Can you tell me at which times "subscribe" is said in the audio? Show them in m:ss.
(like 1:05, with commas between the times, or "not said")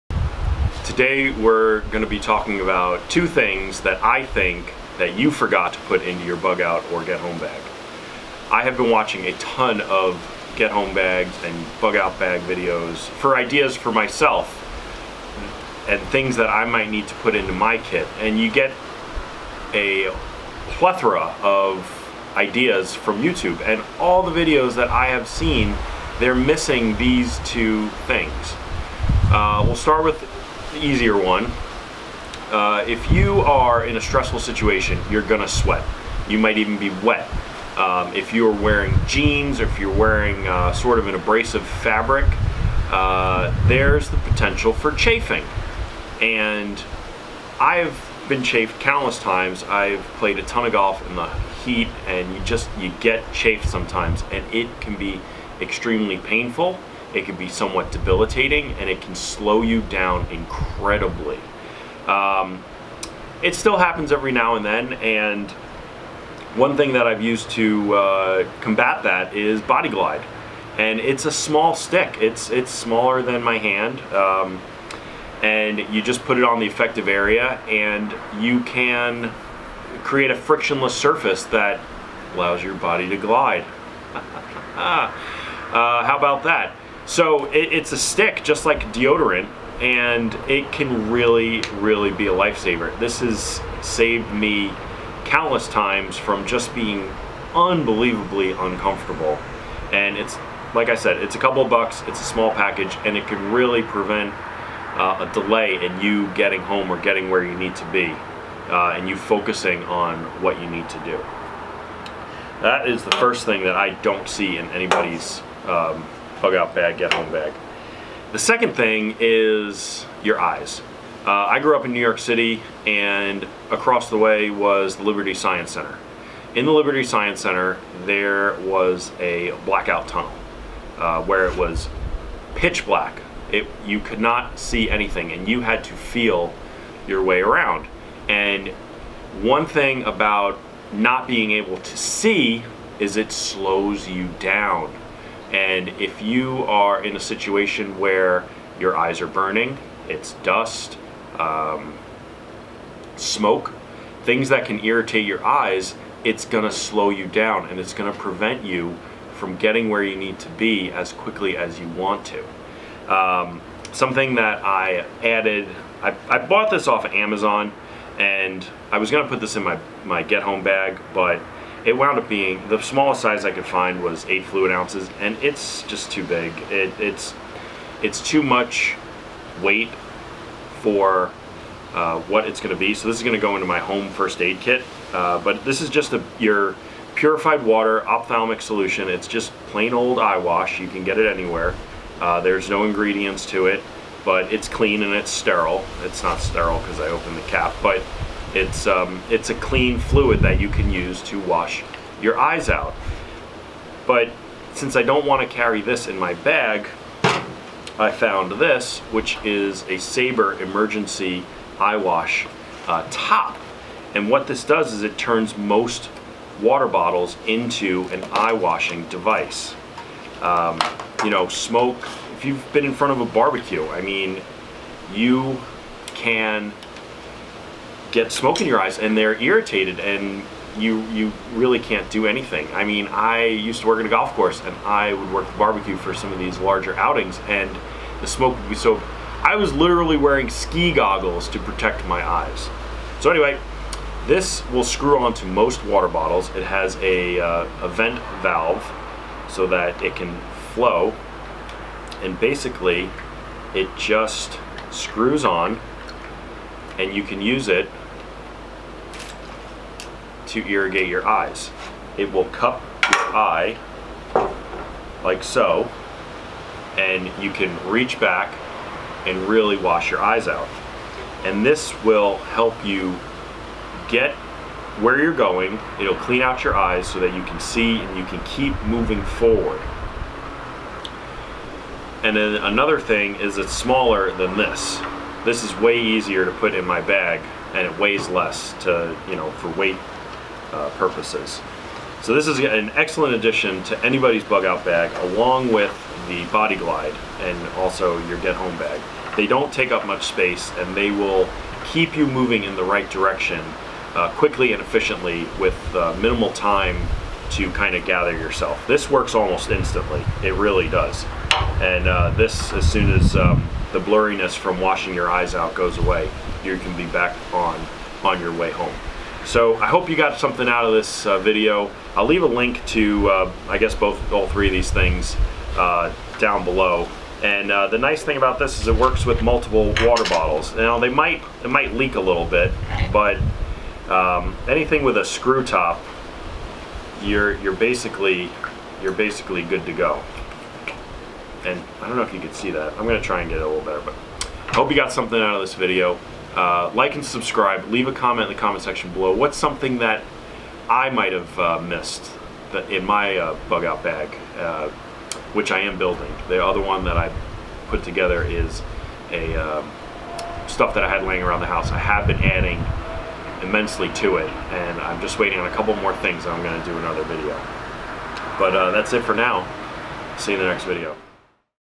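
5:47.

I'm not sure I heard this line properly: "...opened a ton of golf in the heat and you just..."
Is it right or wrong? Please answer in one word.
wrong.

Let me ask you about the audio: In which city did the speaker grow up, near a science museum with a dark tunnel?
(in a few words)
New York City.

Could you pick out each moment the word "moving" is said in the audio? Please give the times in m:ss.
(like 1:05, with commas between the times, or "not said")
4:38, 5:02.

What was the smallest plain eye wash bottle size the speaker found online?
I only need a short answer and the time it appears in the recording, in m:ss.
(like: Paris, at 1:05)
8 fluid ounces, at 2:54.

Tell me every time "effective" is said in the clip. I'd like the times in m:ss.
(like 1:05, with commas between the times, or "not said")
1:16.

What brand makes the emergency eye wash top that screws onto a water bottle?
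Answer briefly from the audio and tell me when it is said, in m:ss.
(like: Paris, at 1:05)
Sabre, at 3:29.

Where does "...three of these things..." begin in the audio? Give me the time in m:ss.
5:24.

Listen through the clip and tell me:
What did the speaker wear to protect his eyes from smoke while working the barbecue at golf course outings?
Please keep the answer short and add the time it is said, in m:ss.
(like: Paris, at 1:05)
ski goggles, at 4:00.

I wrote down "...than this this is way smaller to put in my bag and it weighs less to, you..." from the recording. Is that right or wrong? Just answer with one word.
wrong.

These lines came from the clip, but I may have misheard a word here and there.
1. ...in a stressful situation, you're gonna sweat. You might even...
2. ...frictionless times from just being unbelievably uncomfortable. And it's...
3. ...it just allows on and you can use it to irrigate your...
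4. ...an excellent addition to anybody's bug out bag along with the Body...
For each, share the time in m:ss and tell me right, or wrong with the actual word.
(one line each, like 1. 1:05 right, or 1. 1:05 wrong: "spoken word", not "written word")
1. 0:33 right
2. 1:35 wrong: "countless", not "frictionless"
3. 4:13 wrong: "screws", not "allows"
4. 4:52 right.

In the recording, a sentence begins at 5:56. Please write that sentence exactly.
The other one that I put together is a um, stuff that I had laying around the house.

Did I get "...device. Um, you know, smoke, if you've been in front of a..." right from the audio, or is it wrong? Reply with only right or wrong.
right.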